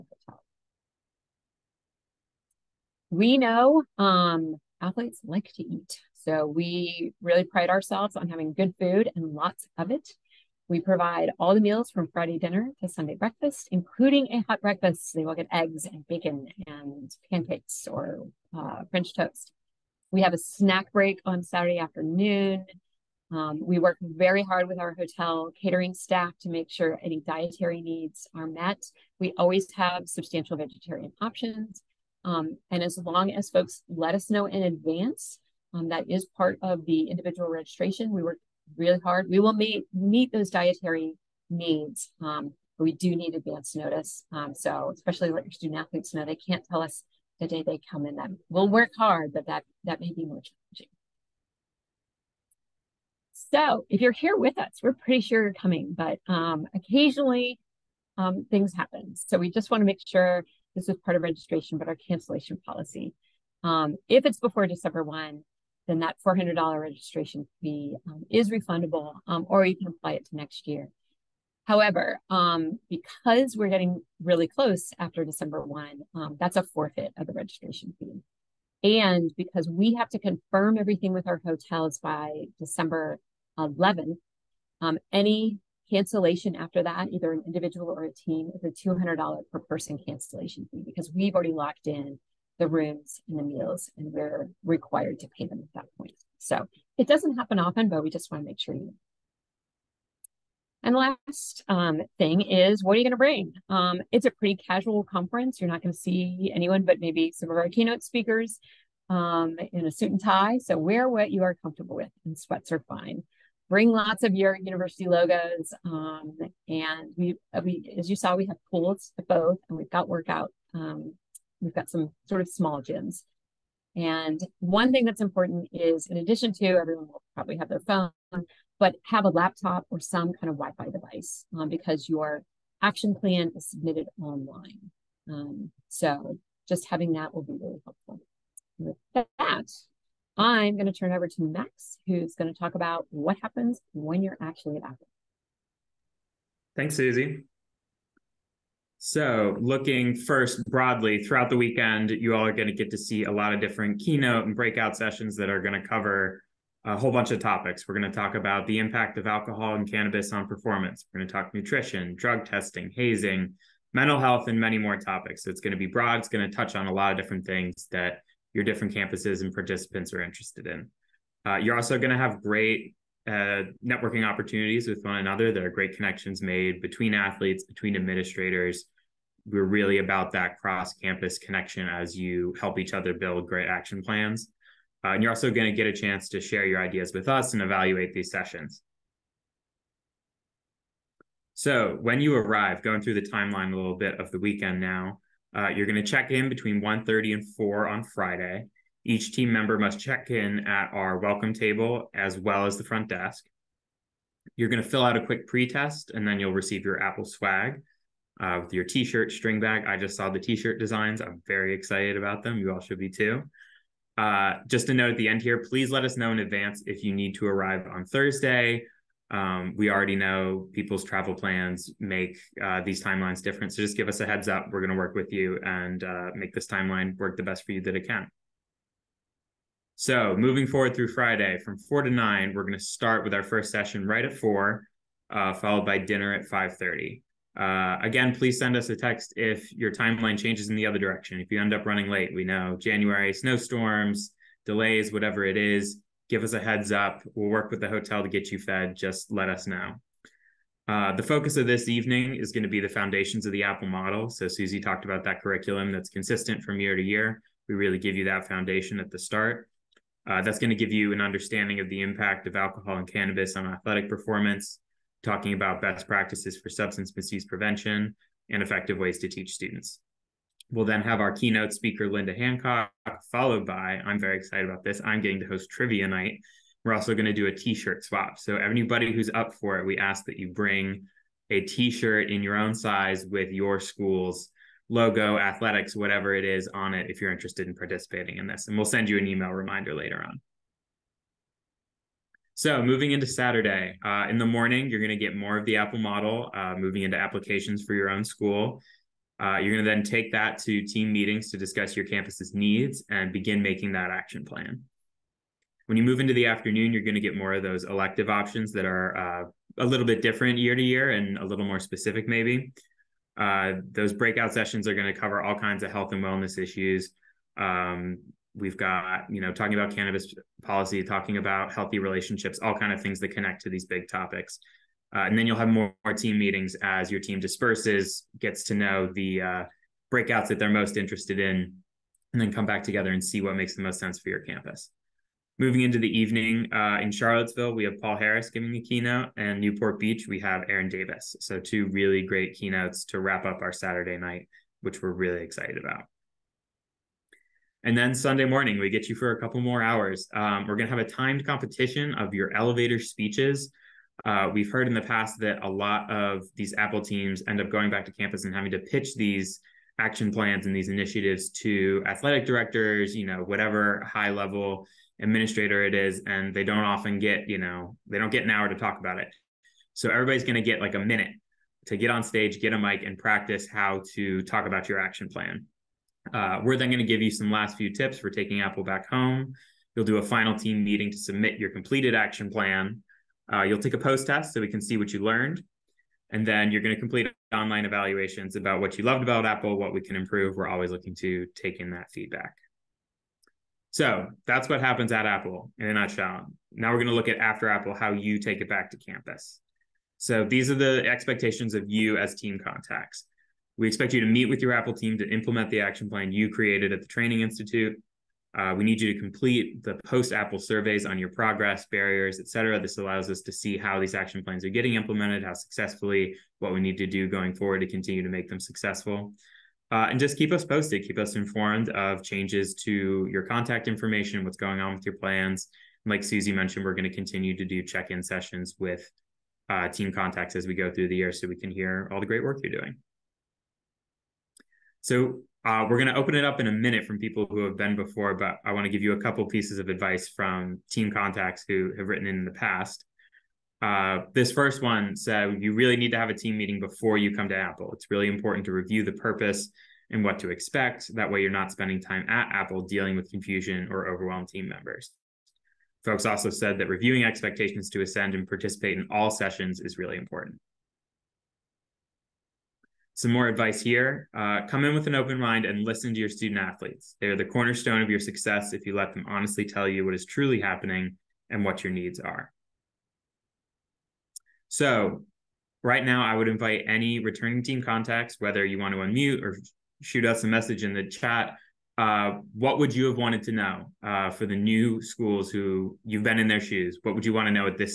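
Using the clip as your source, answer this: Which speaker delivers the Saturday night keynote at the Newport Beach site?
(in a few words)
Aaron Davis.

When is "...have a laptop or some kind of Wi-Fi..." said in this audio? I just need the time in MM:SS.
02:09.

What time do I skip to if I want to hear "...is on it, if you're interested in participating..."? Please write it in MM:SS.
04:46.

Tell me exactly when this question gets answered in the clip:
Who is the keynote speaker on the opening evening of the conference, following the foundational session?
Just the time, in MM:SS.
04:32.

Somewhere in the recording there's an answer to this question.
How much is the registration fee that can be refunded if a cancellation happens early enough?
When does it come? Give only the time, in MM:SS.
01:06.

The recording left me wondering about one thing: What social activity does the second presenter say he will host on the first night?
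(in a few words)
Trivia night.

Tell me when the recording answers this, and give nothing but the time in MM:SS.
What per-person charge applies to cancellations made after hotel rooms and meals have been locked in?
01:28.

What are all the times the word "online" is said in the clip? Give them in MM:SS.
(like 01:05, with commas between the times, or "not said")
02:14, 06:27.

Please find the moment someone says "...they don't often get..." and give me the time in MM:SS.
06:06.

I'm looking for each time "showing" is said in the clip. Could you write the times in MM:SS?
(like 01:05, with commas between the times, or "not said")
not said.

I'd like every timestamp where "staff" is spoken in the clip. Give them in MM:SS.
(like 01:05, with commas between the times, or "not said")
00:25.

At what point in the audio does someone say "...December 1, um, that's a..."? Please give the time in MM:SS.
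01:15.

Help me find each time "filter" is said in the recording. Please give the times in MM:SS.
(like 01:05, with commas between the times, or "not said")
not said.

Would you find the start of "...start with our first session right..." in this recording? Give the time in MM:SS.
03:52.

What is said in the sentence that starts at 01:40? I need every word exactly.
And last um, thing is, what are you going to bring?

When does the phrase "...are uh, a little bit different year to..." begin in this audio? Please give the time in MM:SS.
05:08.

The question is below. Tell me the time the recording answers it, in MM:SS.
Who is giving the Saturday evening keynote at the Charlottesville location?
05:38.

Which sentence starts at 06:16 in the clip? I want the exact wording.
Uh, we're then going to give you some last few tips for taking Apple back home.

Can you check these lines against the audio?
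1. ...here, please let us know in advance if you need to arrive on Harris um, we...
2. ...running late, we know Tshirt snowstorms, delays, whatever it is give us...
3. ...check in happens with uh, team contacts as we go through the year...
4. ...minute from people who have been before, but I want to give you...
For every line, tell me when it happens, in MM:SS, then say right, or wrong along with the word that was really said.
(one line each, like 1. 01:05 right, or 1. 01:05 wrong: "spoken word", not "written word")
1. 03:35 wrong: "Thursday", not "Harris"
2. 04:01 wrong: "January", not "Tshirt"
3. 07:07 wrong: "sessions", not "happens"
4. 07:16 right.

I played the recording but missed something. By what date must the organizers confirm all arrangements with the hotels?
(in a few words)
December 11.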